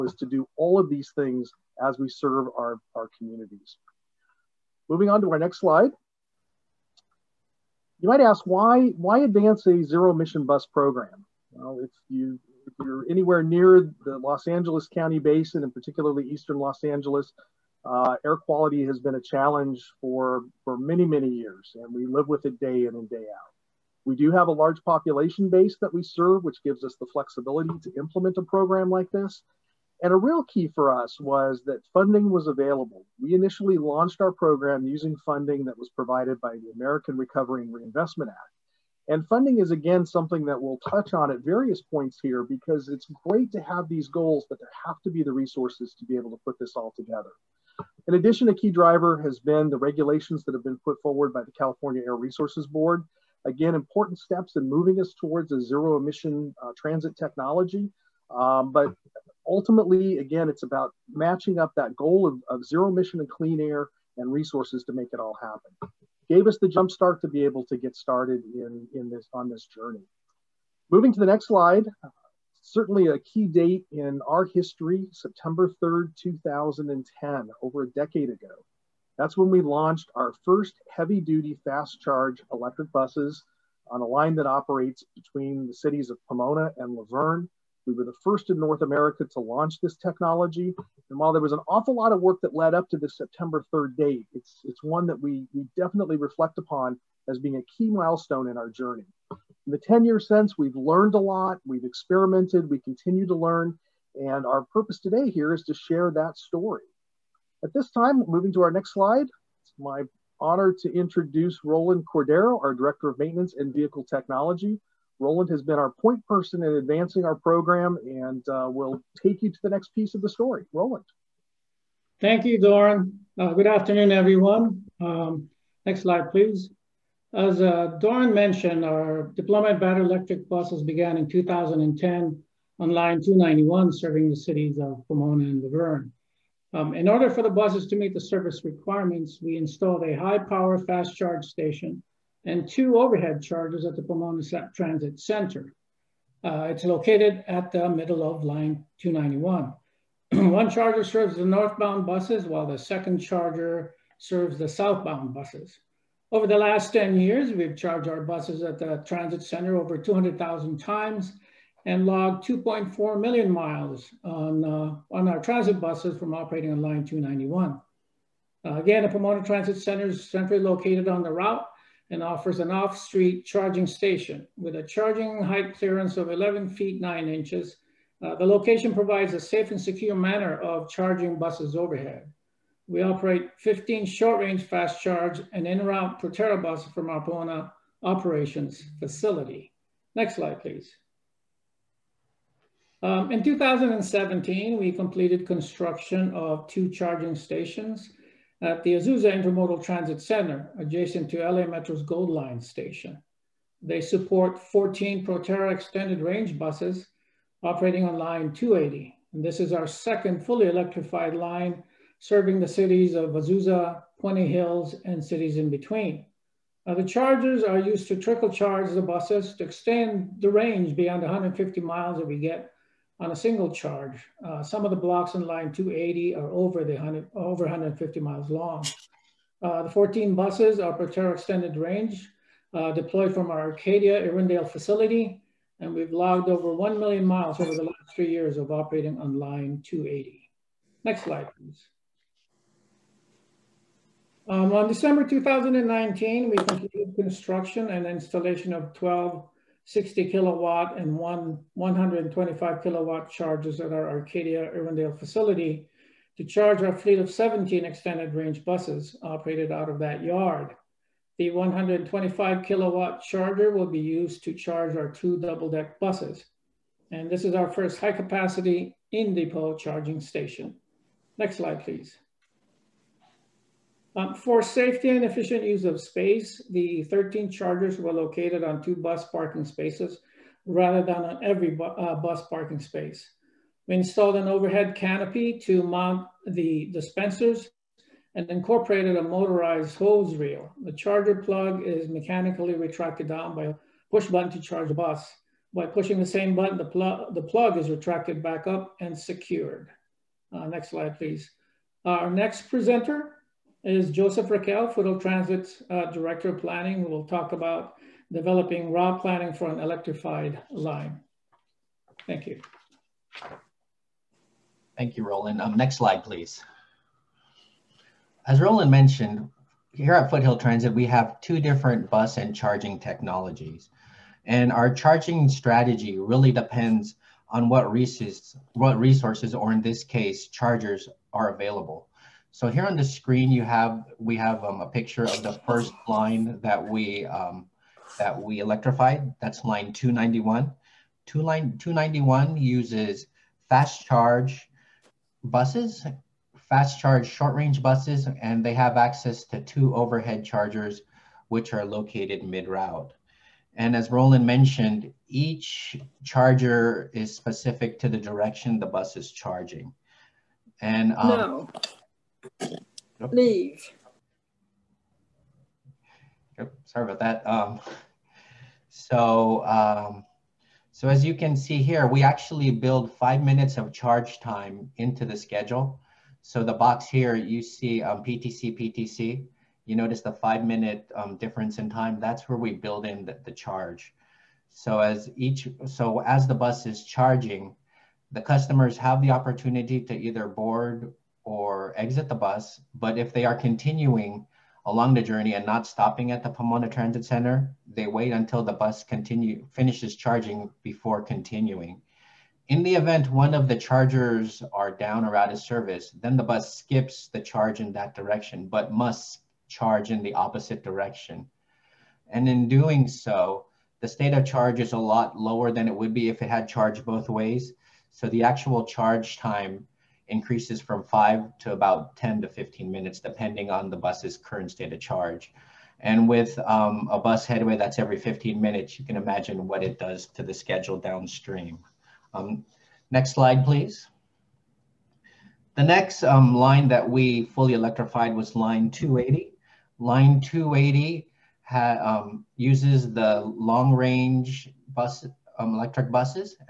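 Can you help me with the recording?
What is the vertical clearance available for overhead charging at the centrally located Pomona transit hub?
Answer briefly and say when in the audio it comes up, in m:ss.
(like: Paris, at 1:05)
11 feet 9 inches, at 2:56.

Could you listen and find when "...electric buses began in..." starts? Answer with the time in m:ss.
2:10.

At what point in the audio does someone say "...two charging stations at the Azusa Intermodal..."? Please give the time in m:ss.
3:16.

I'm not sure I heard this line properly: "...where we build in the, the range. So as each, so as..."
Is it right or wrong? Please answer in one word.
wrong.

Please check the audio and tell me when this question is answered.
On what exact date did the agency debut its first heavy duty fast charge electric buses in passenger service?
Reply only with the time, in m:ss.
1:15.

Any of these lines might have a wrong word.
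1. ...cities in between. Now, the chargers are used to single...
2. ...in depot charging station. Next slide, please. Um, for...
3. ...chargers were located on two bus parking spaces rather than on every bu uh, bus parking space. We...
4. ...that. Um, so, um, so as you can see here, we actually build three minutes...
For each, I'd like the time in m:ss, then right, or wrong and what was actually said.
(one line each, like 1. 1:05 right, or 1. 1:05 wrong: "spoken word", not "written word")
1. 3:35 wrong: "trickle", not "single"
2. 4:29 right
3. 4:37 right
4. 6:07 wrong: "five", not "three".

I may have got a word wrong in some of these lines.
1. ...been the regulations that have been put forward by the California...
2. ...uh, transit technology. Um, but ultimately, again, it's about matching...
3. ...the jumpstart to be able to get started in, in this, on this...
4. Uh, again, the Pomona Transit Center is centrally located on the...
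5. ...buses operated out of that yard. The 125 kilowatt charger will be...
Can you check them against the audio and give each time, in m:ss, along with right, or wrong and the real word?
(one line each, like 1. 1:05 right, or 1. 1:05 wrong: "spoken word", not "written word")
1. 0:49 right
2. 0:56 right
3. 1:06 right
4. 2:48 right
5. 4:18 right.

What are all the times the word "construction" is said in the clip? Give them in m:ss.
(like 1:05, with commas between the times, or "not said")
3:15, 4:07.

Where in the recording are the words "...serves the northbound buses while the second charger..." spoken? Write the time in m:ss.
2:31.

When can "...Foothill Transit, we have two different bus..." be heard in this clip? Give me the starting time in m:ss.
5:20.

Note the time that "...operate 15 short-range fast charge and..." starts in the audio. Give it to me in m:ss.
3:03.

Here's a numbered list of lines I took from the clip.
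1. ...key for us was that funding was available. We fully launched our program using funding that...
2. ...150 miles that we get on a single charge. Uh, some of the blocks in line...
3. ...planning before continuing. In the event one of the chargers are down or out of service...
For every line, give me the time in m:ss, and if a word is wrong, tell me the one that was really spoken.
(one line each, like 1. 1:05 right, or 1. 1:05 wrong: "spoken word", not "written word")
1. 0:30 wrong: "initially", not "fully"
2. 3:41 right
3. 6:40 wrong: "charging", not "planning".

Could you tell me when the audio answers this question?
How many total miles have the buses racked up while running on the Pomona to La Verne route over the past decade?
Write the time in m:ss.
2:42.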